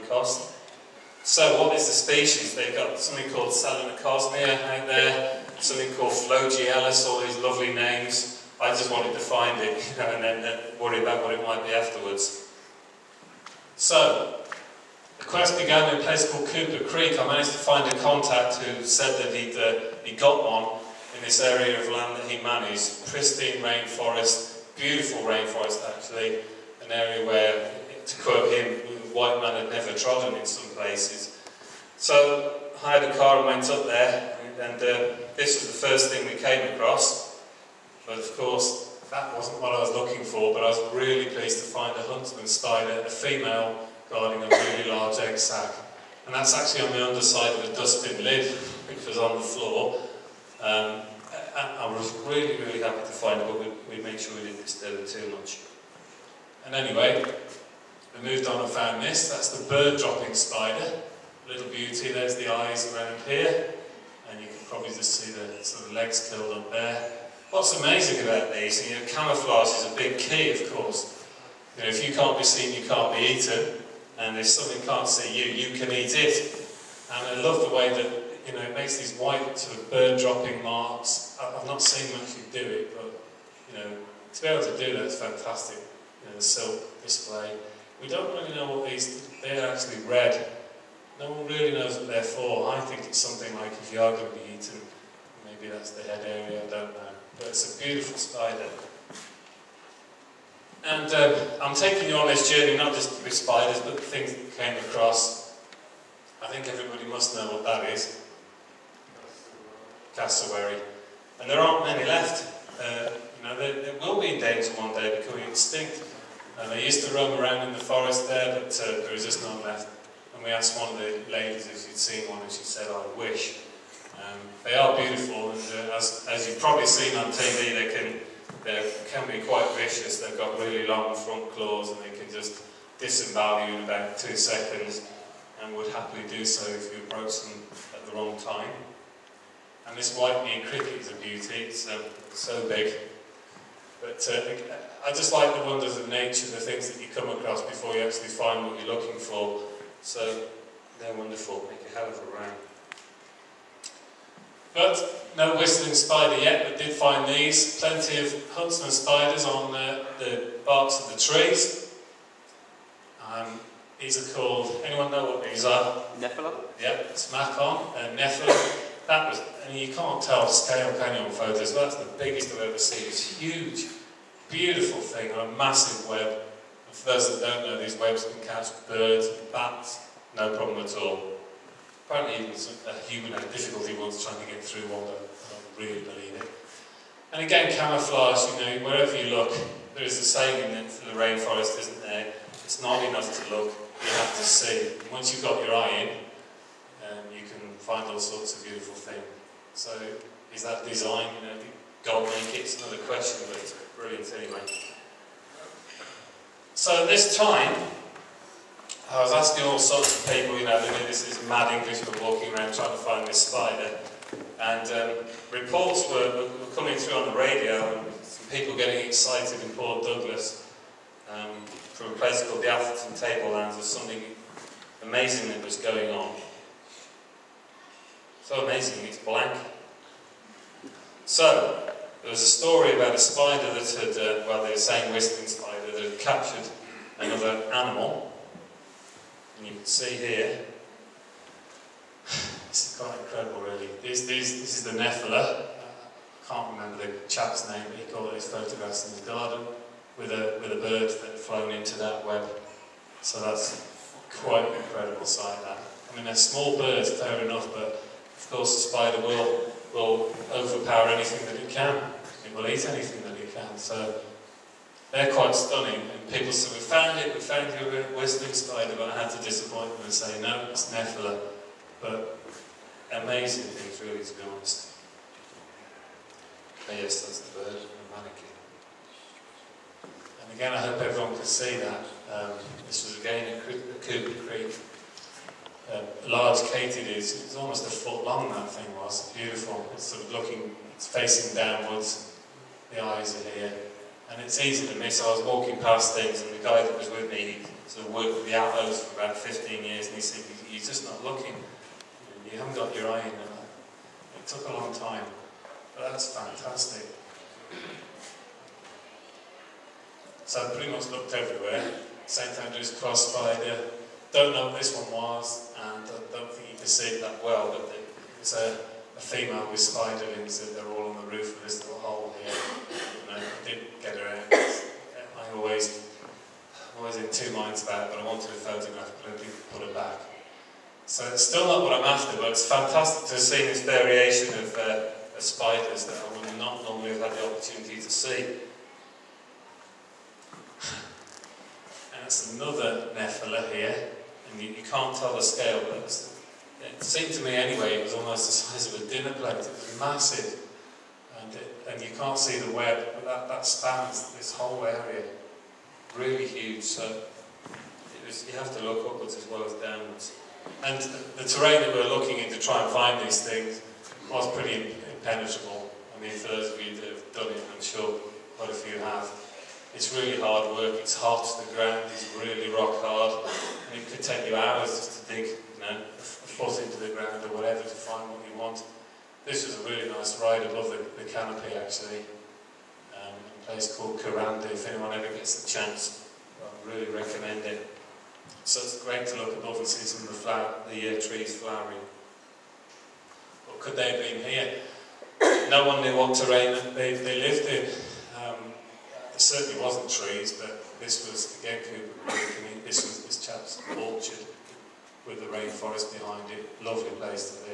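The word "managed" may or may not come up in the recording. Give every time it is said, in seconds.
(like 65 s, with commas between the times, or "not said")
17 s, 22 s.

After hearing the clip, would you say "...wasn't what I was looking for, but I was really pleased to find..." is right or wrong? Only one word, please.
right.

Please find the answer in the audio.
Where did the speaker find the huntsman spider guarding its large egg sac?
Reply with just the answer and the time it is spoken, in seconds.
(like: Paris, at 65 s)
Underside of a dustbin lid, at 47 s.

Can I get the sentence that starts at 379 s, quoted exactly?
This is a really nice ride above the, the canopy actually.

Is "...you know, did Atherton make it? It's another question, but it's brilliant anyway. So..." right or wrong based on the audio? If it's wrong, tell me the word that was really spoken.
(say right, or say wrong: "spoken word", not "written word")
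wrong: "God", not "Atherton".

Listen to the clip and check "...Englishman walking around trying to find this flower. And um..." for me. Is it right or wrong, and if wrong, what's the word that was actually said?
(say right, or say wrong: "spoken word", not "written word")
wrong: "spider", not "flower".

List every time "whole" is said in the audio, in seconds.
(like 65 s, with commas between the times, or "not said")
354 s.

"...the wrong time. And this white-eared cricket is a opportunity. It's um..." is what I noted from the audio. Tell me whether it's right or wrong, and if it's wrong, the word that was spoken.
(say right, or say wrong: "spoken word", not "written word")
wrong: "beauty", not "opportunity".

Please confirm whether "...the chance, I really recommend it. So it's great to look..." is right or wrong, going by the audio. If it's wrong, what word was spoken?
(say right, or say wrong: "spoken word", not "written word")
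right.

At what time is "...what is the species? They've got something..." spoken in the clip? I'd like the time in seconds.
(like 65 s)
1 s.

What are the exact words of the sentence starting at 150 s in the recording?
So they're wonderful, make a hell of a round.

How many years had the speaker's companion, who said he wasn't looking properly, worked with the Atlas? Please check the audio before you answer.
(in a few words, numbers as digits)
15.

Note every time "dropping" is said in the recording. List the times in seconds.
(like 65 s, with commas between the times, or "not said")
59 s, 80 s.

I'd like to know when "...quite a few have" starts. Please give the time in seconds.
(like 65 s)
368 s.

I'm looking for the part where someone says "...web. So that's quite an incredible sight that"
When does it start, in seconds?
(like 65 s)
252 s.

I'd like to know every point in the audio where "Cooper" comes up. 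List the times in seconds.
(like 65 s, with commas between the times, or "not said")
16 s, 284 s.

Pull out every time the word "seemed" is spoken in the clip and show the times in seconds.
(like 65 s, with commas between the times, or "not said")
347 s.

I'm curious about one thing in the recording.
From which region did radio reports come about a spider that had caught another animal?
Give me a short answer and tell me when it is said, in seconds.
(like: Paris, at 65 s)
Atherton Tablelands, at 222 s.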